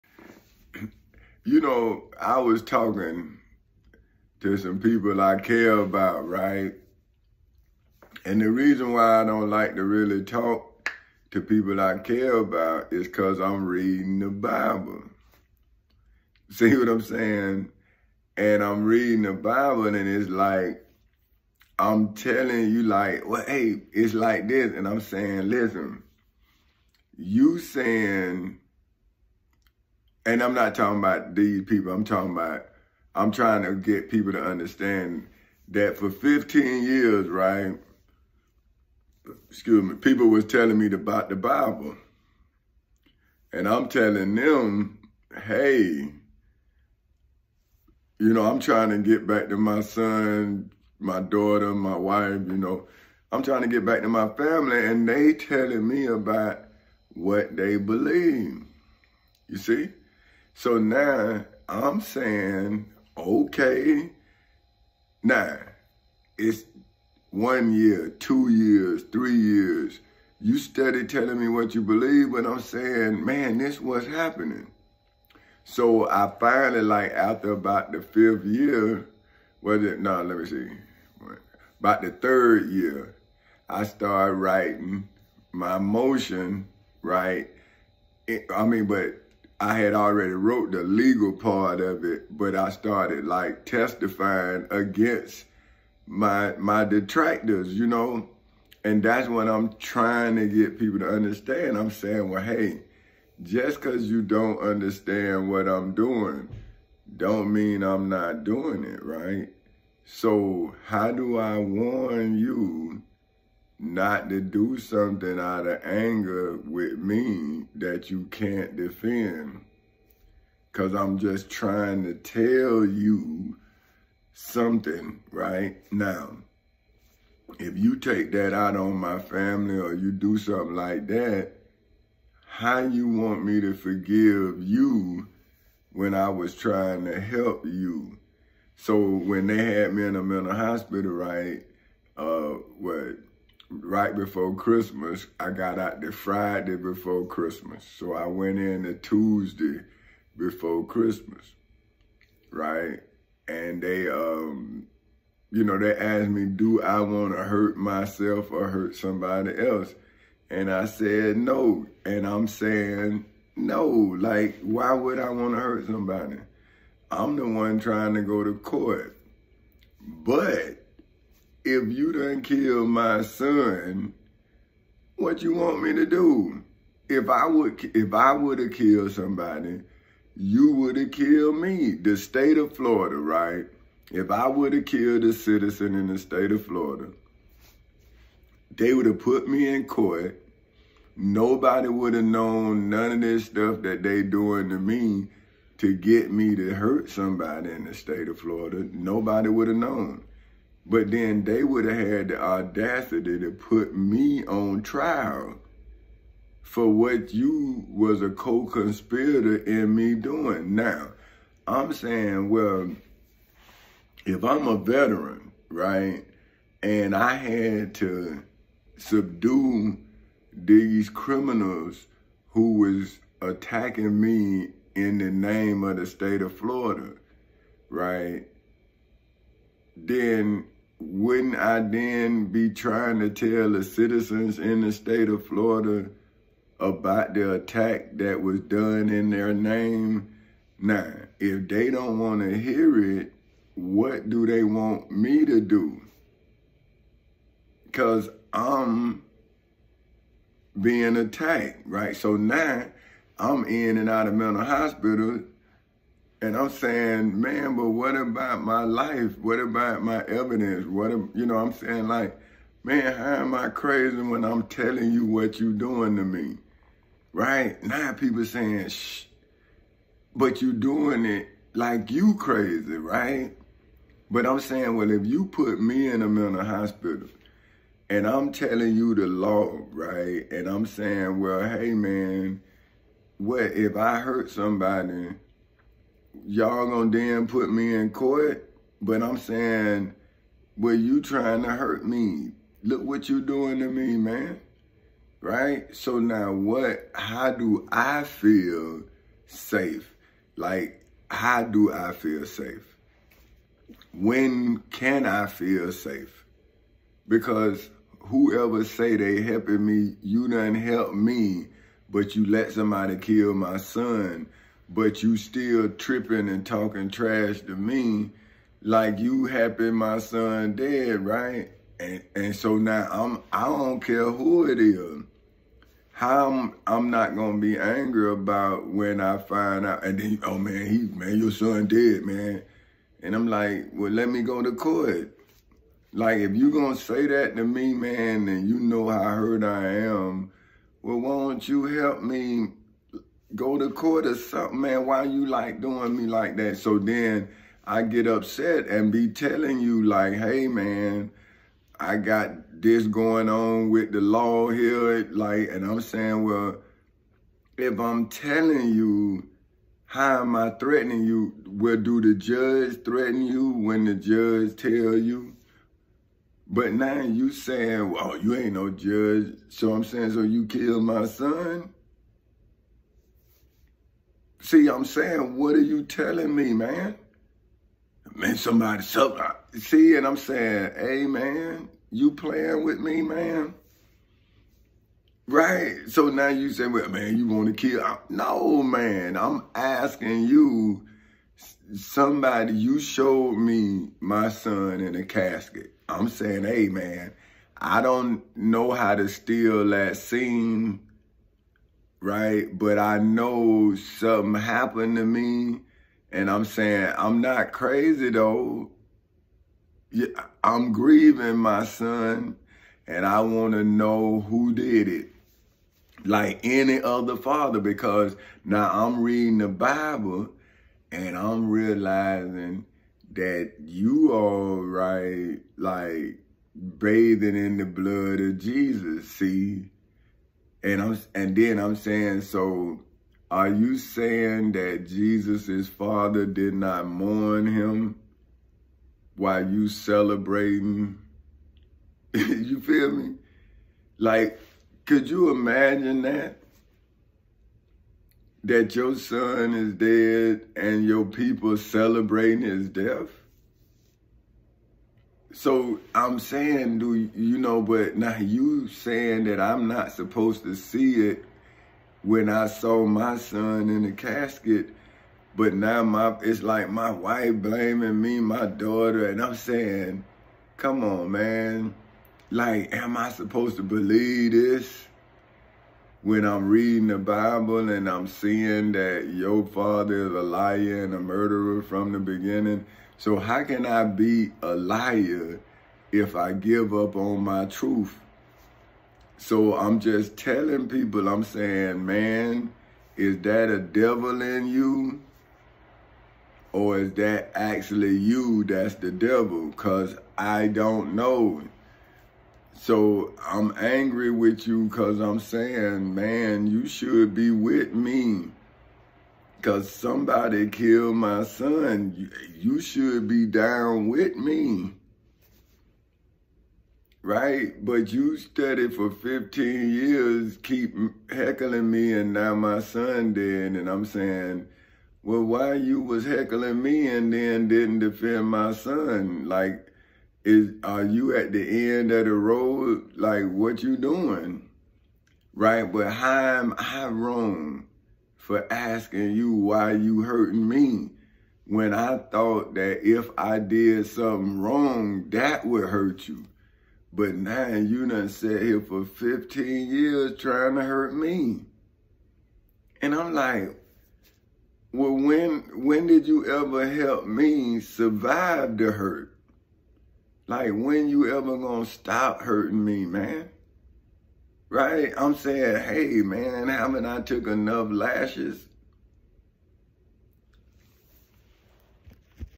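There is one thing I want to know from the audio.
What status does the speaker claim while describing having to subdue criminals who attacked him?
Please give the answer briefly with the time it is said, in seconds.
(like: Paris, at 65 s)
veteran, at 214 s.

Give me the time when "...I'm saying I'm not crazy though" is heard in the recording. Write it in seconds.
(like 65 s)
406 s.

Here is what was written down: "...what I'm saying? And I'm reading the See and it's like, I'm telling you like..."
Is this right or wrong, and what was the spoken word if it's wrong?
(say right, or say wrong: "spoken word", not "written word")
wrong: "Bible", not "See".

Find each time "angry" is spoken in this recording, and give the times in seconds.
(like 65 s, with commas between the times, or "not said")
327 s, 503 s.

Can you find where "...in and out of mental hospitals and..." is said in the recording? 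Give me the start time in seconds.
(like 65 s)
253 s.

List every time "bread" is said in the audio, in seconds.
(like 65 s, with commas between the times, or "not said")
not said.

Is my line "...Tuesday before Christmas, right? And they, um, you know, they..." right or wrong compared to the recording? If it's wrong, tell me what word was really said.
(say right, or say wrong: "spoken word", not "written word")
right.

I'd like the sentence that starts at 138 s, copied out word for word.
So when they had me in a mental hospital, right, uh, what, right before Christmas.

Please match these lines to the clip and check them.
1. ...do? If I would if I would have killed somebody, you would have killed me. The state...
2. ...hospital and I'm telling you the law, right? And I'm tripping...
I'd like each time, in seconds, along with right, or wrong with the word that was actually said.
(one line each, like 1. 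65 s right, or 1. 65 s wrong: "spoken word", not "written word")
1. 176 s right
2. 276 s wrong: "saying", not "tripping".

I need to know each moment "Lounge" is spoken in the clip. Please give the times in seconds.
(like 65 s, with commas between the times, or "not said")
not said.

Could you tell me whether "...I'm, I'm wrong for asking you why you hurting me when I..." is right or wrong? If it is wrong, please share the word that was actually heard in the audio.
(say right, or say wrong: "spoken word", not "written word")
right.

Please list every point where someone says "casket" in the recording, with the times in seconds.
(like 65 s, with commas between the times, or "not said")
395 s, 464 s.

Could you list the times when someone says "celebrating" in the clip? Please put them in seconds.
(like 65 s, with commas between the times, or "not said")
439 s, 451 s.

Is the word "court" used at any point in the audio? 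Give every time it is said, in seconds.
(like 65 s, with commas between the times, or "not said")
168 s, 189 s, 288 s, 334 s, 343 s.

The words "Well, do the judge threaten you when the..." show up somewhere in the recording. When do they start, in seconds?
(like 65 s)
361 s.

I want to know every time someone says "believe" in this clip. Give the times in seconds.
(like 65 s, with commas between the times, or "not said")
57 s, 71 s, 473 s.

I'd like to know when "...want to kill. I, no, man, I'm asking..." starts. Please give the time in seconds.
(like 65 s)
387 s.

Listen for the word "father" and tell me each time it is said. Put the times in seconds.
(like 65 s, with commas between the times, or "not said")
417 s, 435 s, 479 s.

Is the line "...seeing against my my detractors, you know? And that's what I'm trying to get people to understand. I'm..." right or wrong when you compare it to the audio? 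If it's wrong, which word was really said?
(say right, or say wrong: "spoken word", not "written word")
wrong: "testifying", not "seeing".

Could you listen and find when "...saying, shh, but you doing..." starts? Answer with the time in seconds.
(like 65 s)
268 s.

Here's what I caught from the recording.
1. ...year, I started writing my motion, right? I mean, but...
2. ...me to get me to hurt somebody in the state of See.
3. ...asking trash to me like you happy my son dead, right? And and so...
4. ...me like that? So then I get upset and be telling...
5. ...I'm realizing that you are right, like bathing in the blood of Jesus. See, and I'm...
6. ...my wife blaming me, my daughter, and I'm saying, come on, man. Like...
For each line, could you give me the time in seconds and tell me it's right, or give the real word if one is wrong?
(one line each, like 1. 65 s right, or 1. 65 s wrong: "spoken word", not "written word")
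1. 82 s right
2. 194 s wrong: "Florida", not "See"
3. 316 s wrong: "talking", not "asking"
4. 346 s right
5. 421 s right
6. 466 s right.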